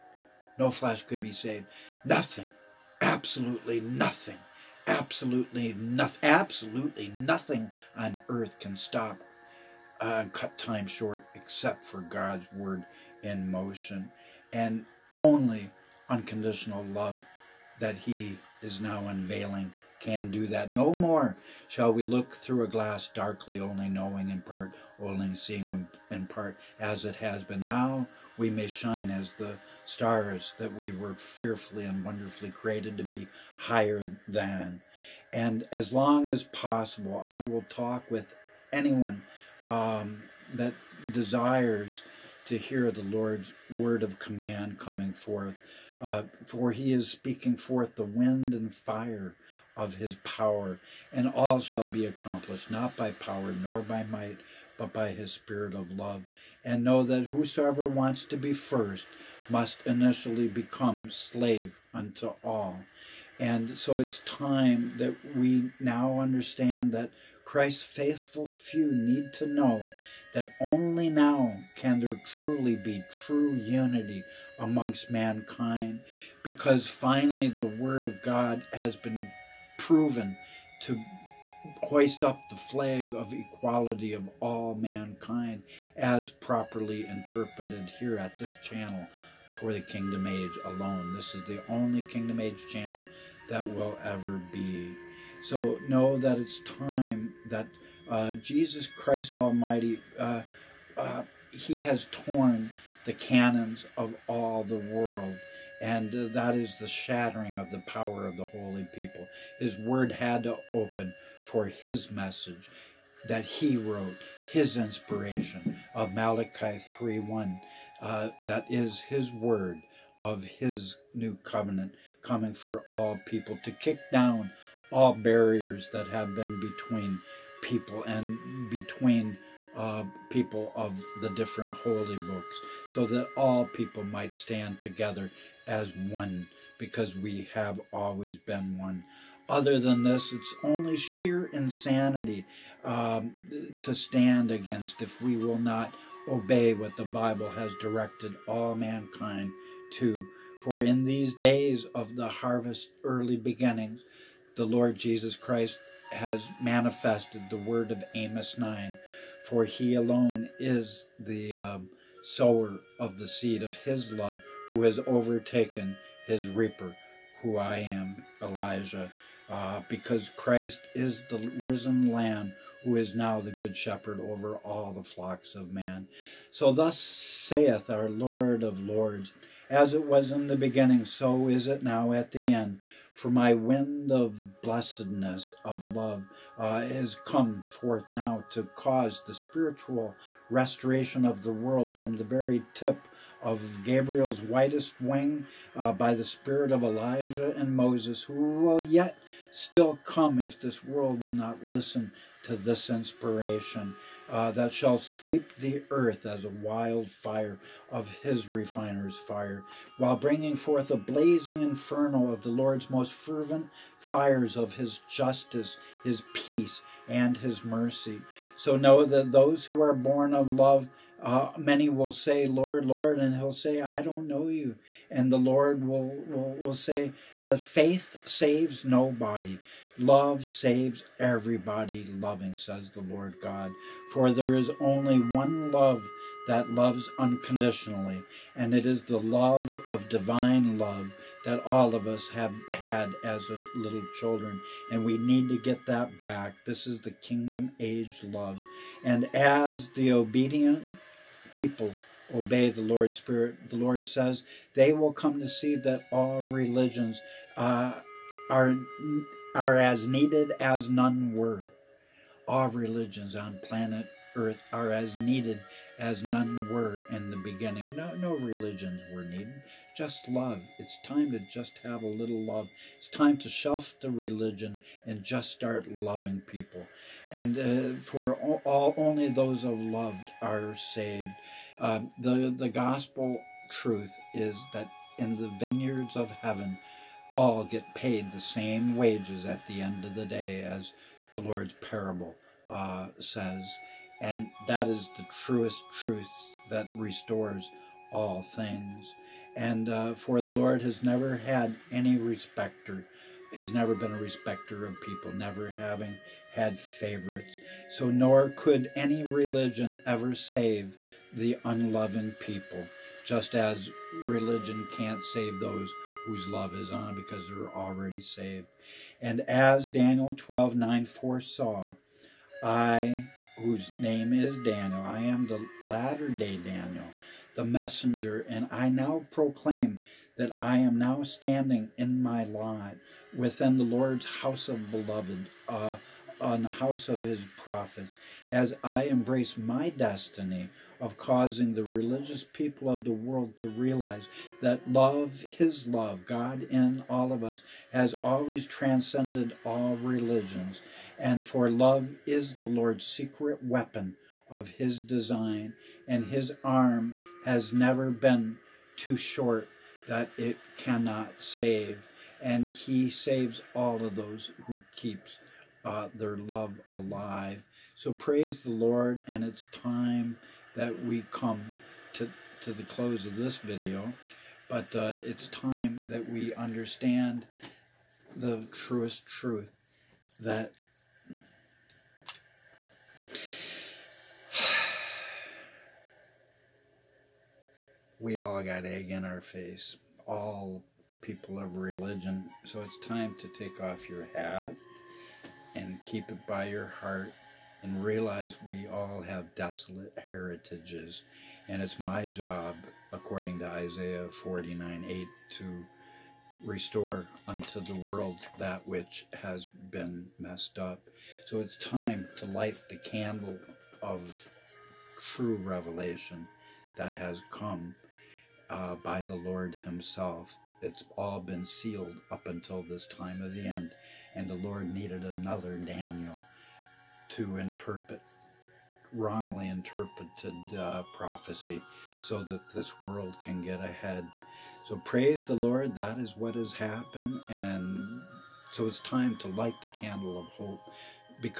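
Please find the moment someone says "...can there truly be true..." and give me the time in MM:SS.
01:11.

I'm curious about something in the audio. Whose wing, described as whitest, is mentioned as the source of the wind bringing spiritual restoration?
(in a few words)
Gabriel.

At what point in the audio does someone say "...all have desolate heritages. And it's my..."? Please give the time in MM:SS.
06:38.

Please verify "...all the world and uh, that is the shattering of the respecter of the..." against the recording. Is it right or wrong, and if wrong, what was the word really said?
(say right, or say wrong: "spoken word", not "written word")
wrong: "power", not "respecter".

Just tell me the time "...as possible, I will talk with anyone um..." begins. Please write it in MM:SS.
00:36.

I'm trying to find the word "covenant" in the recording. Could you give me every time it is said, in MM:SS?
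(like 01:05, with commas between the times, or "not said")
02:01.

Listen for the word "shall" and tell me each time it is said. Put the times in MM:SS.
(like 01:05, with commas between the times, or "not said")
00:21, 00:51, 03:24.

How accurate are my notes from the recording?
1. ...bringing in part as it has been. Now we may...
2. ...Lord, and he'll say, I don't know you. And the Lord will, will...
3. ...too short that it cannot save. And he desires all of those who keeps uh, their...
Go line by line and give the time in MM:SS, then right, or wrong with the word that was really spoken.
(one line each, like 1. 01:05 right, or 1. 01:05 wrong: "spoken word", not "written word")
1. 00:25 wrong: "seeing", not "bringing"
2. 03:42 right
3. 05:58 wrong: "saves", not "desires".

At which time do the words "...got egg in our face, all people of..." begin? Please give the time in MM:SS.
06:28.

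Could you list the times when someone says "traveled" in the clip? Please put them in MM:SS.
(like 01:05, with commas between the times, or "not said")
not said.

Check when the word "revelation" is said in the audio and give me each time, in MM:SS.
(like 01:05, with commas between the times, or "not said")
06:55.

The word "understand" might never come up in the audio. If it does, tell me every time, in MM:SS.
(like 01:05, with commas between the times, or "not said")
01:06, 06:16.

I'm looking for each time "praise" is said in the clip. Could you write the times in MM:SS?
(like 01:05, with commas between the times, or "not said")
06:08, 07:14.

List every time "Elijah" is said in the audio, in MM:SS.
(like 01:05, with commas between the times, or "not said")
02:48, 03:16.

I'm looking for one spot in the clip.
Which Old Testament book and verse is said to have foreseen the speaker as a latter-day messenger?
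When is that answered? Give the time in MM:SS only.
05:19.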